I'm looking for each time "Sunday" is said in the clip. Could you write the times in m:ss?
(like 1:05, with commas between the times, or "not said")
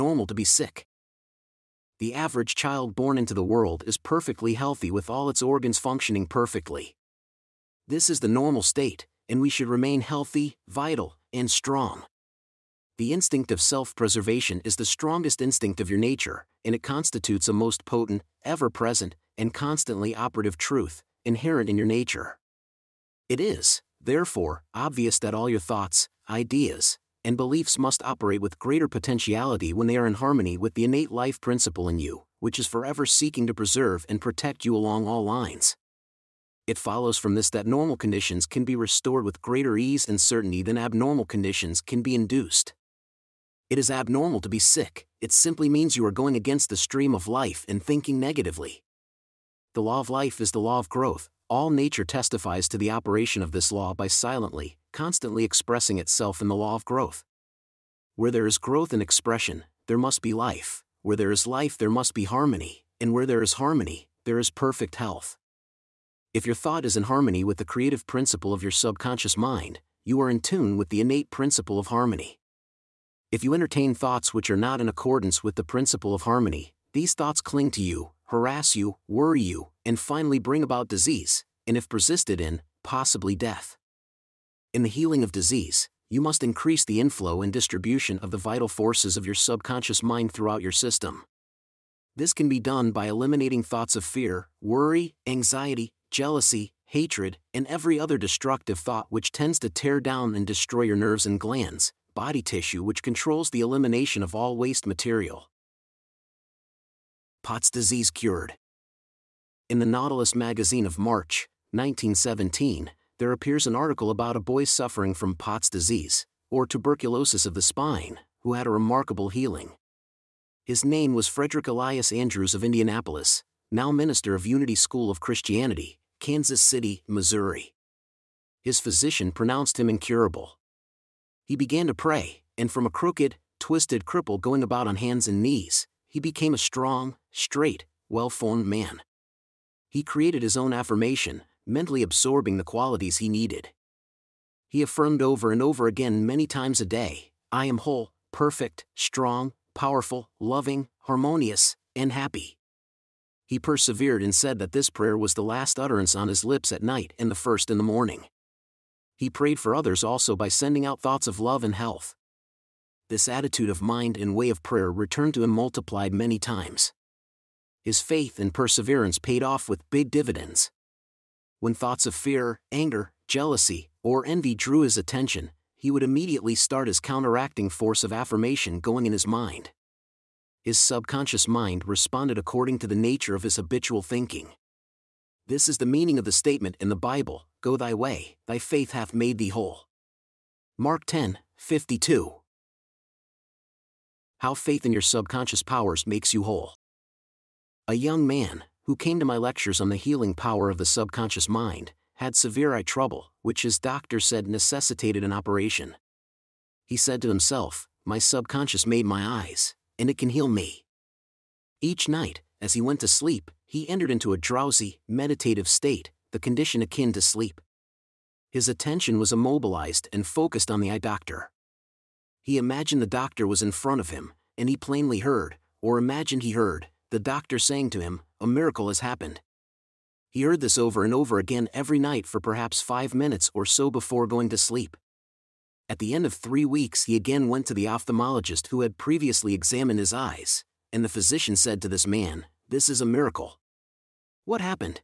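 not said.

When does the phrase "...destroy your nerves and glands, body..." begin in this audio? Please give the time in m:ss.
1:40.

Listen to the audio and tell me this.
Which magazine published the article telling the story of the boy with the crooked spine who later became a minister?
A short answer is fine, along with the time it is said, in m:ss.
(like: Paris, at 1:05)
Nautilus, at 1:49.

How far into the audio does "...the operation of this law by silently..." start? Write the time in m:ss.
0:52.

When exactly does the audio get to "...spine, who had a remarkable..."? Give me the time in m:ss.
1:57.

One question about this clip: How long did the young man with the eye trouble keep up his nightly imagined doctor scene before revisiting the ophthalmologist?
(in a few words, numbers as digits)
3 weeks.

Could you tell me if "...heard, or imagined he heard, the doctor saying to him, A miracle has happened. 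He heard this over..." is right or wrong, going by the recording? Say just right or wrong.
right.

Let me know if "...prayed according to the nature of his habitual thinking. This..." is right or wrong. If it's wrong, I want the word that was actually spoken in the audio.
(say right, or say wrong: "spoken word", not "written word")
wrong: "responded", not "prayed".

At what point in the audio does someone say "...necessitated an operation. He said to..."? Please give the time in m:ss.
3:24.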